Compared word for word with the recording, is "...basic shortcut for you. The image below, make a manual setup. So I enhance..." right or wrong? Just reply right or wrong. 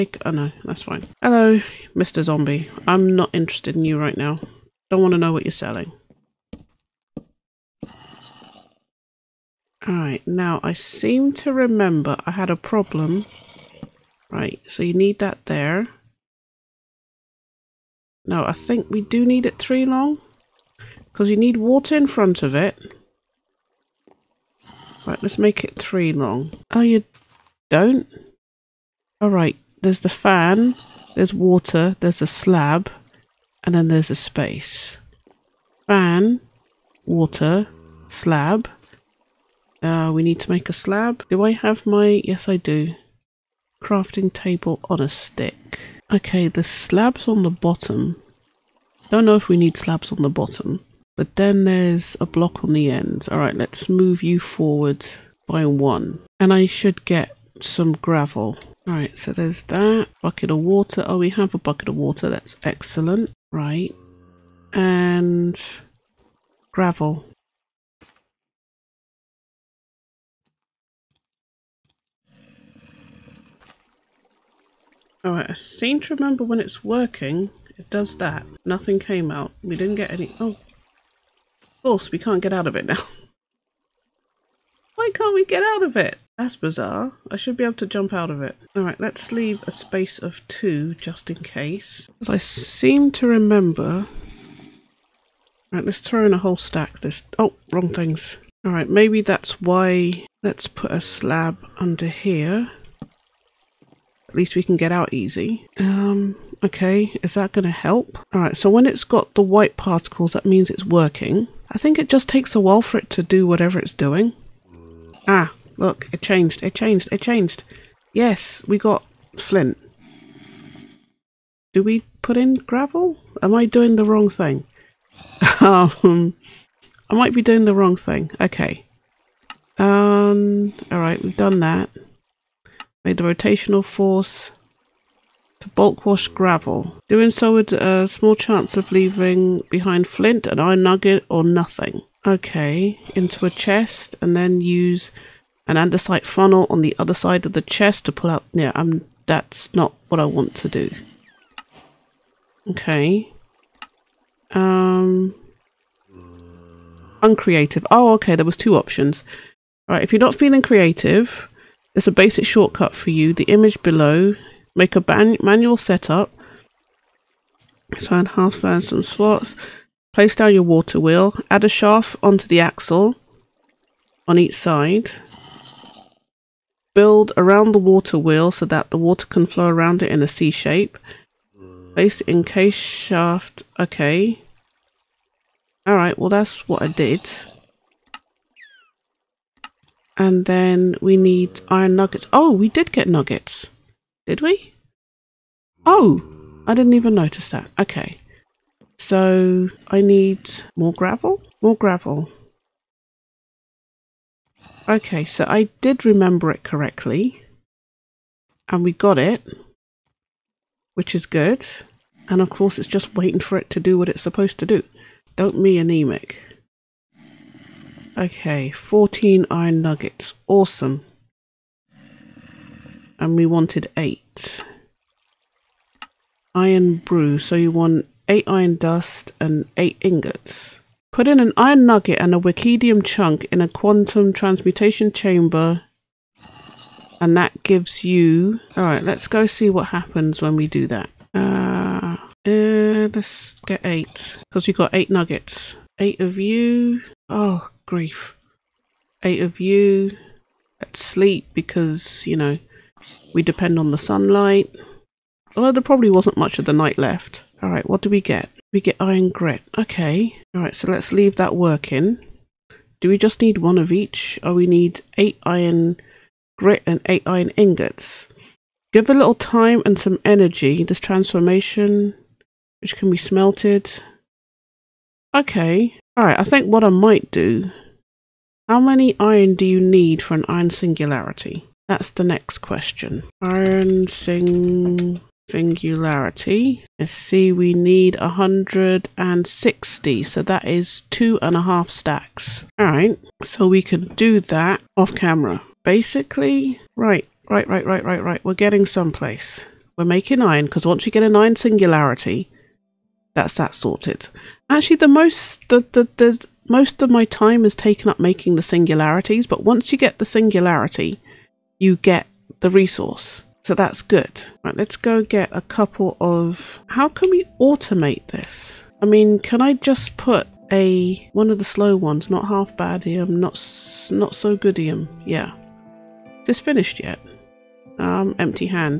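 right.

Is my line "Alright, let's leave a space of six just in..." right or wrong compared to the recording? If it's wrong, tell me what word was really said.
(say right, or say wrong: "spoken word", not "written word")
wrong: "two", not "six".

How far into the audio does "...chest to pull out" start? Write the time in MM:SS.
02:27.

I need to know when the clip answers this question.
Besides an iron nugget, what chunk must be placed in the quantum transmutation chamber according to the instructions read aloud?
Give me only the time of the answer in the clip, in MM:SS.
03:52.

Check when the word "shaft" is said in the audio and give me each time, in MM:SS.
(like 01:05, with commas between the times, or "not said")
02:51, 03:02.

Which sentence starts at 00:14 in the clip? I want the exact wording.
Right, so you need that there.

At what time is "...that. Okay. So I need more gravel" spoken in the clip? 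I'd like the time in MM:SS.
03:17.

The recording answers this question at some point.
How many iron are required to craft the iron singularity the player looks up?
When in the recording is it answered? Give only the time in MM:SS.
04:48.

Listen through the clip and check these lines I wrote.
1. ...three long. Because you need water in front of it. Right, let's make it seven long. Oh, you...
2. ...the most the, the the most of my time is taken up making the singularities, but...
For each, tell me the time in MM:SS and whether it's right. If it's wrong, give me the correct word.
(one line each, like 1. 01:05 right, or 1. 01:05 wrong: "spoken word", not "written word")
1. 00:19 wrong: "three", not "seven"
2. 05:04 right.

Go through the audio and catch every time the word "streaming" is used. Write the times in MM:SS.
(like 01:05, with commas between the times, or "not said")
not said.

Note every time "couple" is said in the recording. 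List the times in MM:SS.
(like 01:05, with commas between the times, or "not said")
05:15.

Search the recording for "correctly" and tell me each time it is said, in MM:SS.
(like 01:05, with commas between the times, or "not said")
03:26.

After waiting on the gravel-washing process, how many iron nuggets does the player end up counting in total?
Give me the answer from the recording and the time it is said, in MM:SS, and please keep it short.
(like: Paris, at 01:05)
14, at 03:38.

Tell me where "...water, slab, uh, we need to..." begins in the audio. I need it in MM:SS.
00:37.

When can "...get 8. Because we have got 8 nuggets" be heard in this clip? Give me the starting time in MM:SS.
04:03.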